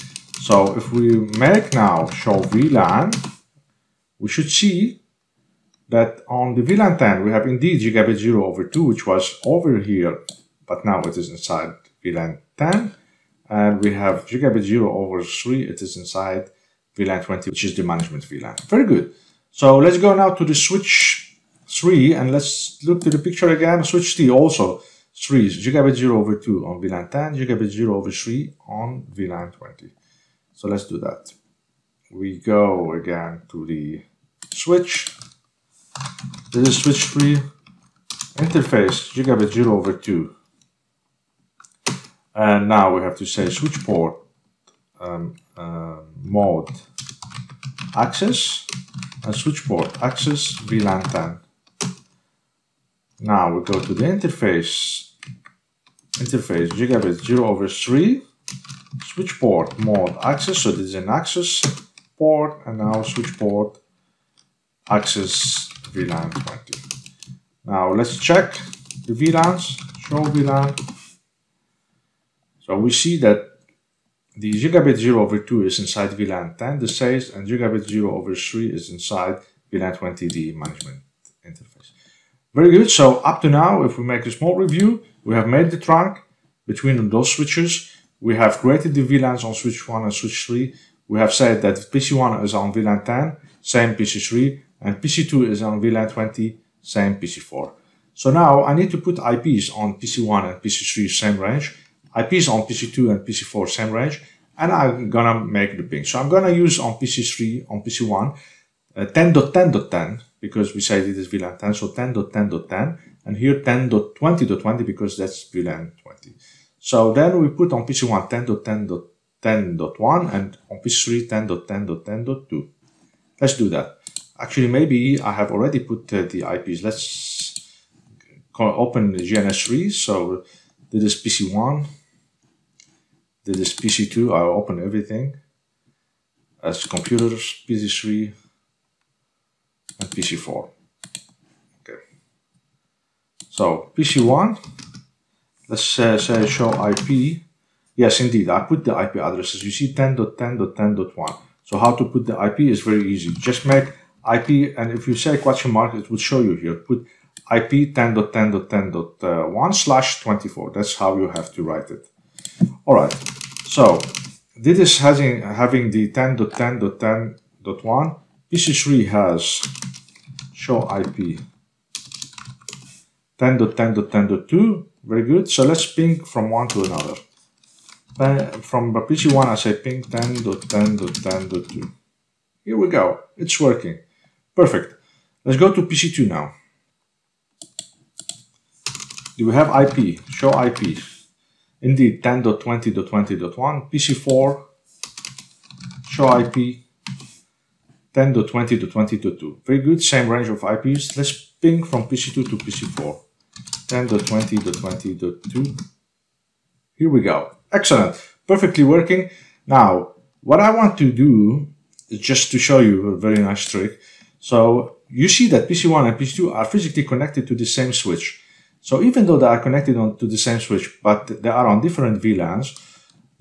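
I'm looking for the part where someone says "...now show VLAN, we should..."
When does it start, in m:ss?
0:01.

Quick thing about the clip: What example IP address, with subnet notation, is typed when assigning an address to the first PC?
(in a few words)
10.10.10.1/24.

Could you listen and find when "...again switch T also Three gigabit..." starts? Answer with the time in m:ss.
0:23.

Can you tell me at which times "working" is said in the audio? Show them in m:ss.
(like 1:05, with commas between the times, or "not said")
3:03, 3:28.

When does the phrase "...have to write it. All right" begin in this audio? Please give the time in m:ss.
2:41.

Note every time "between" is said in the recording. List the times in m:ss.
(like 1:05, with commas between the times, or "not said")
1:26.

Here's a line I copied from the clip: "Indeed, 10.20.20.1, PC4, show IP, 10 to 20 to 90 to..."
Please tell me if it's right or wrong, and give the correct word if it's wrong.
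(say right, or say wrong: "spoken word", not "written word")
wrong: "20", not "90".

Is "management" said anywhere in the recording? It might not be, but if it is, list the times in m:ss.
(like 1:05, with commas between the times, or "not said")
0:17, 1:20.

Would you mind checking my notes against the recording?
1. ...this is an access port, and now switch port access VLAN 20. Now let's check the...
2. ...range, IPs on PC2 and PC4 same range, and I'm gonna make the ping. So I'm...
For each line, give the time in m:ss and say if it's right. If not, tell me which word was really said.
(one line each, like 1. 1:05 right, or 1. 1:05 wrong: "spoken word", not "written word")
1. 1:00 right
2. 1:41 right.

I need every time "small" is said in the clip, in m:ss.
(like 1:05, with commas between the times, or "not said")
1:24.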